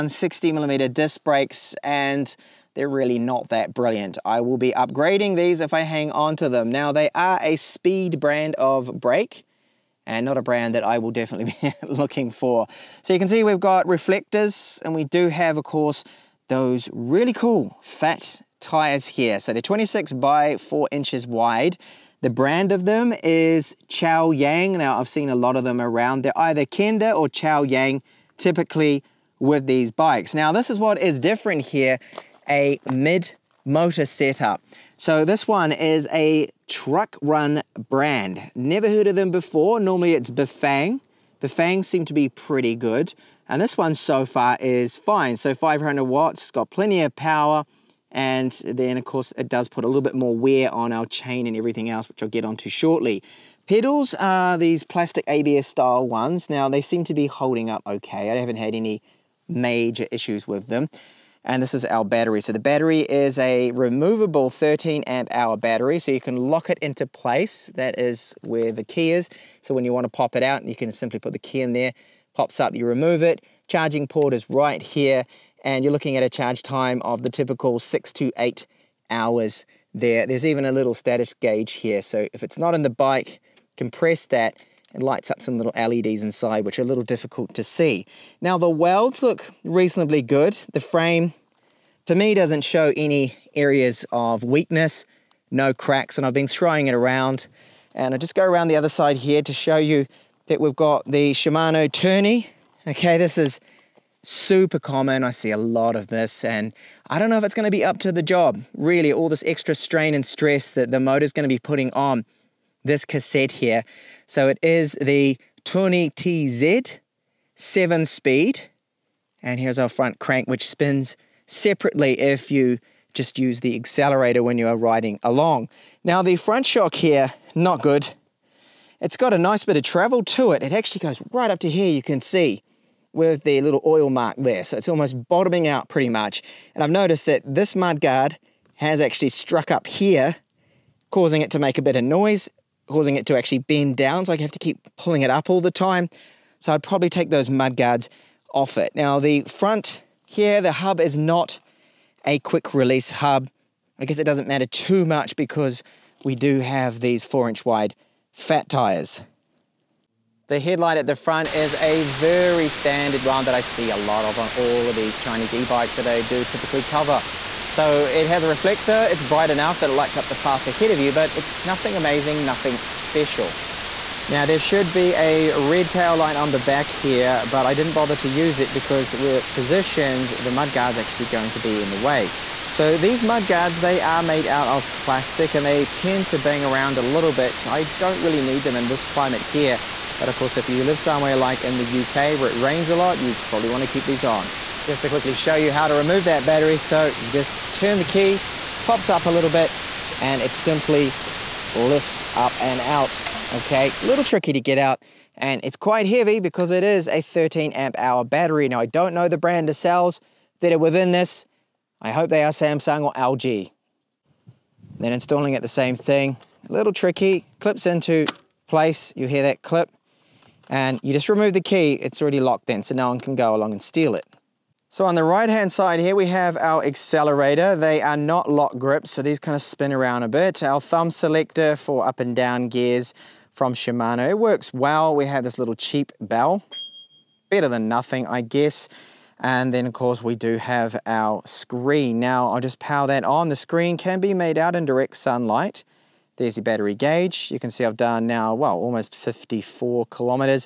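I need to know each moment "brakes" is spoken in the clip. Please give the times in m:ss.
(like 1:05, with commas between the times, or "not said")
0:01, 0:08.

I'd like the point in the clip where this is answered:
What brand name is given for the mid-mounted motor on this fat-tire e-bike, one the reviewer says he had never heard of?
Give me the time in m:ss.
0:36.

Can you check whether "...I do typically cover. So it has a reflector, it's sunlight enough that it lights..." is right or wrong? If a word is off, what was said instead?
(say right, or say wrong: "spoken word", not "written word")
wrong: "bright", not "sunlight".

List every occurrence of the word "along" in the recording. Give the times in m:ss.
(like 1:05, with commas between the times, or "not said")
2:05, 3:43.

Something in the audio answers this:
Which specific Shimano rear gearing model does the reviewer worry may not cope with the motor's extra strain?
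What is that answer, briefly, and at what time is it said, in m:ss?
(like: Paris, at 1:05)
Tourney TZ 7 speed, at 1:55.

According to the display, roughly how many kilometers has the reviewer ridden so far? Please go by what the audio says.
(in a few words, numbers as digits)
54 kilometers.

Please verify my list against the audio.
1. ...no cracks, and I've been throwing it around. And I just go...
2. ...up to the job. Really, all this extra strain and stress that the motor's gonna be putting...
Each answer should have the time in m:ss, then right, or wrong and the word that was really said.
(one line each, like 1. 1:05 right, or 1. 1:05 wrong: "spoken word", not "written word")
1. 1:35 right
2. 1:47 right.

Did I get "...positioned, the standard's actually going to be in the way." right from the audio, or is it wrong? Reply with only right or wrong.
wrong.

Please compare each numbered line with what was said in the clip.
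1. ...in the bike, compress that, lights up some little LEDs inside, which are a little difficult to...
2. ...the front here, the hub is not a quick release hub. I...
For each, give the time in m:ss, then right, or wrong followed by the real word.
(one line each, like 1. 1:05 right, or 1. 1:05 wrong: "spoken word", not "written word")
1. 1:22 right
2. 2:29 right.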